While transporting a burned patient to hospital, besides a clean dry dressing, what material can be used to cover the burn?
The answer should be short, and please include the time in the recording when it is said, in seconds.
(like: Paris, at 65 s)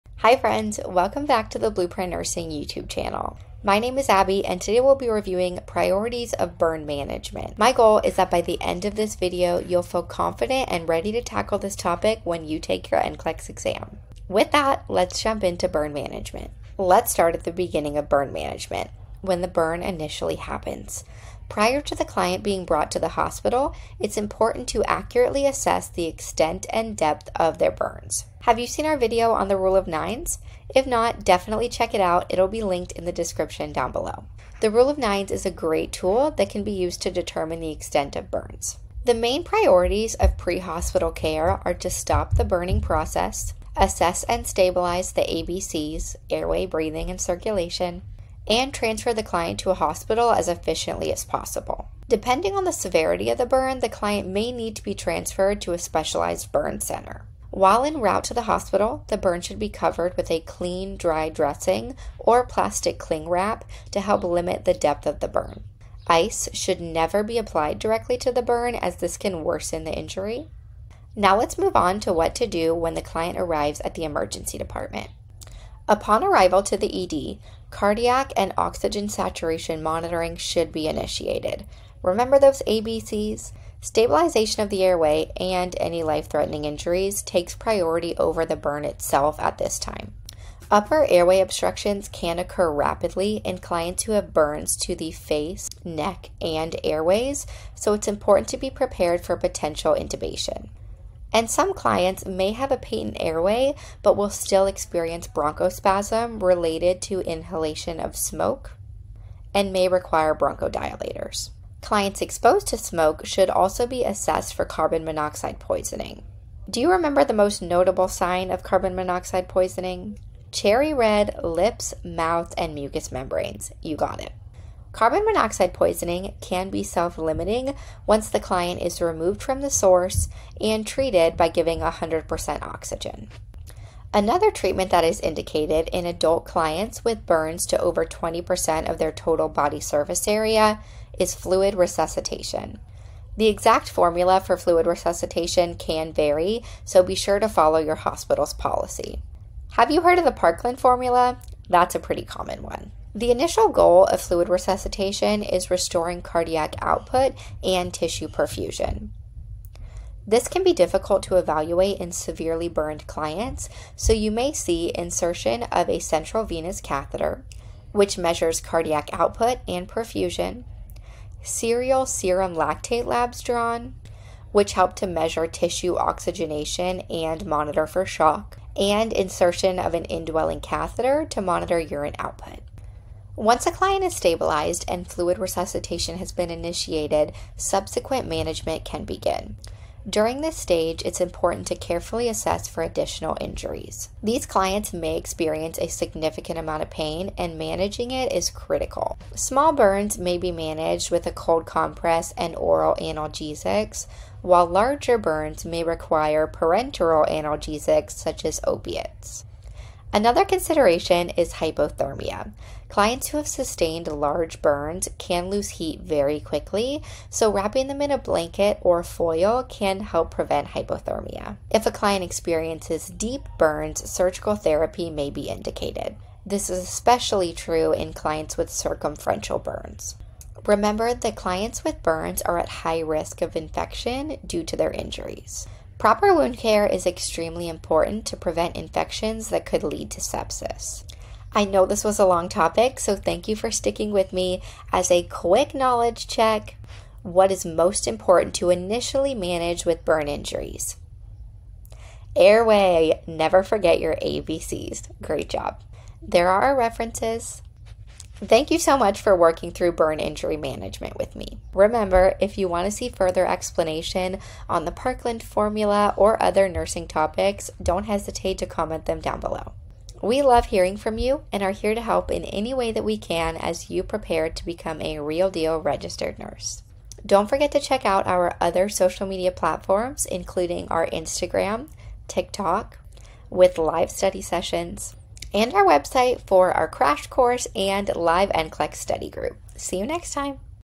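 plastic cling wrap, at 62 s.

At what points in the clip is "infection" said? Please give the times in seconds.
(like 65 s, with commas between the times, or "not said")
233 s, 238 s.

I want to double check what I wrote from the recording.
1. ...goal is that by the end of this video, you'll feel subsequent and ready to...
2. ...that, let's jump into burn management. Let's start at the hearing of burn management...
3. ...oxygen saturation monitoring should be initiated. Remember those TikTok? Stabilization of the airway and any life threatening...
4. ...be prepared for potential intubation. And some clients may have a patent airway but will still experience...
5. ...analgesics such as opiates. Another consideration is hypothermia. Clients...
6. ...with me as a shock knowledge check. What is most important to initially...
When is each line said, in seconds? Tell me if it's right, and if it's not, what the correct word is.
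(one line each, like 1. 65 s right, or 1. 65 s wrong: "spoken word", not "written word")
1. 7 s wrong: "confident", not "subsequent"
2. 14 s wrong: "beginning", not "hearing"
3. 78 s wrong: "ABCs", not "TikTok"
4. 98 s right
5. 207 s right
6. 244 s wrong: "quick", not "shock".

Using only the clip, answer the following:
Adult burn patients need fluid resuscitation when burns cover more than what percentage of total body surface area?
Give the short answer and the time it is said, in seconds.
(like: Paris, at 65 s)
20%, at 138 s.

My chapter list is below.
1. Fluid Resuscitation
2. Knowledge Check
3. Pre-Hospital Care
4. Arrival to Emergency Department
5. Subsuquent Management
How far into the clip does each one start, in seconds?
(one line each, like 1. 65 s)
1. 133 s
2. 241 s
3. 17 s
4. 76 s
5. 183 s.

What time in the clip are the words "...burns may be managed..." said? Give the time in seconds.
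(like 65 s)
199 s.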